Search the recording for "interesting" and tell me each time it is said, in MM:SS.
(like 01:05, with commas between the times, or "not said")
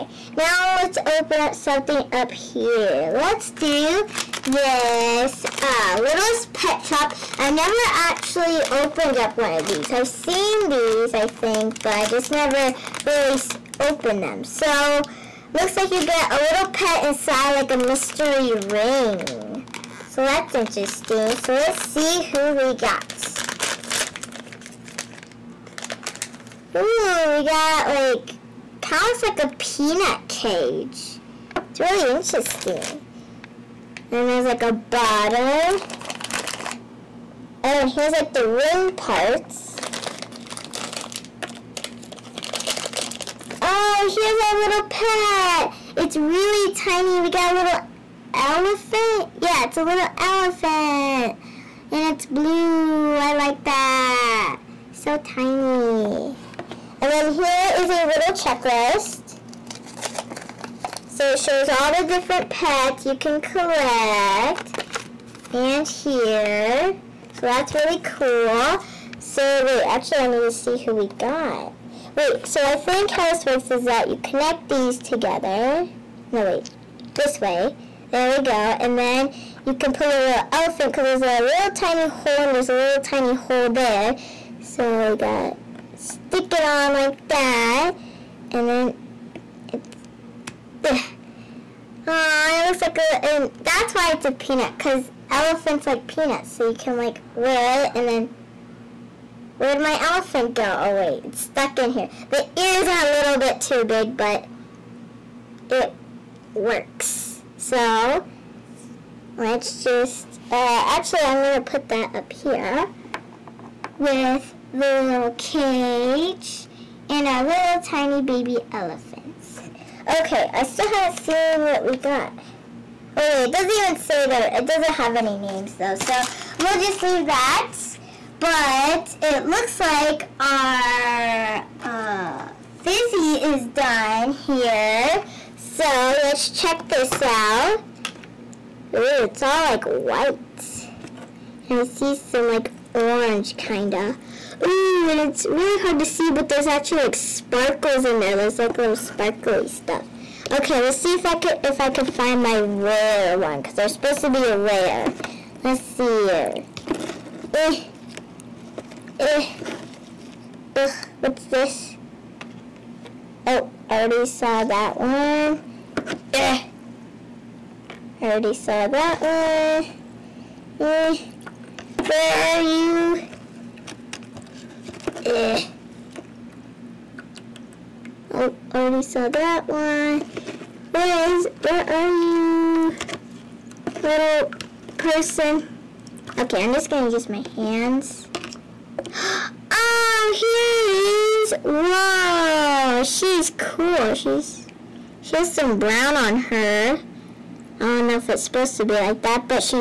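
00:20, 00:32.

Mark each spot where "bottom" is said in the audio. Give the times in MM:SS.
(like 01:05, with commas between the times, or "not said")
00:34.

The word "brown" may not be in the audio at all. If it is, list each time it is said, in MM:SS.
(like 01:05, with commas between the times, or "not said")
03:15.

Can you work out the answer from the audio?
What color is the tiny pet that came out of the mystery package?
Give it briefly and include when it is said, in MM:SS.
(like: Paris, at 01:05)
Blue, at 00:52.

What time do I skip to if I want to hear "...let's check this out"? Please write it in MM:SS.
02:16.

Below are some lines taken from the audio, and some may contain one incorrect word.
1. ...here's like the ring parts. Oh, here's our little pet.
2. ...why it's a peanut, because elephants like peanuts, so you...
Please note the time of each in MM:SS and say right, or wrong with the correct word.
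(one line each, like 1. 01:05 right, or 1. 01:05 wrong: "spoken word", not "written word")
1. 00:37 right
2. 01:33 right.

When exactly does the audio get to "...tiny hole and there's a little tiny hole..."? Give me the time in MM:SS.
01:21.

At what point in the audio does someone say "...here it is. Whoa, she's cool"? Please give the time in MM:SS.
03:10.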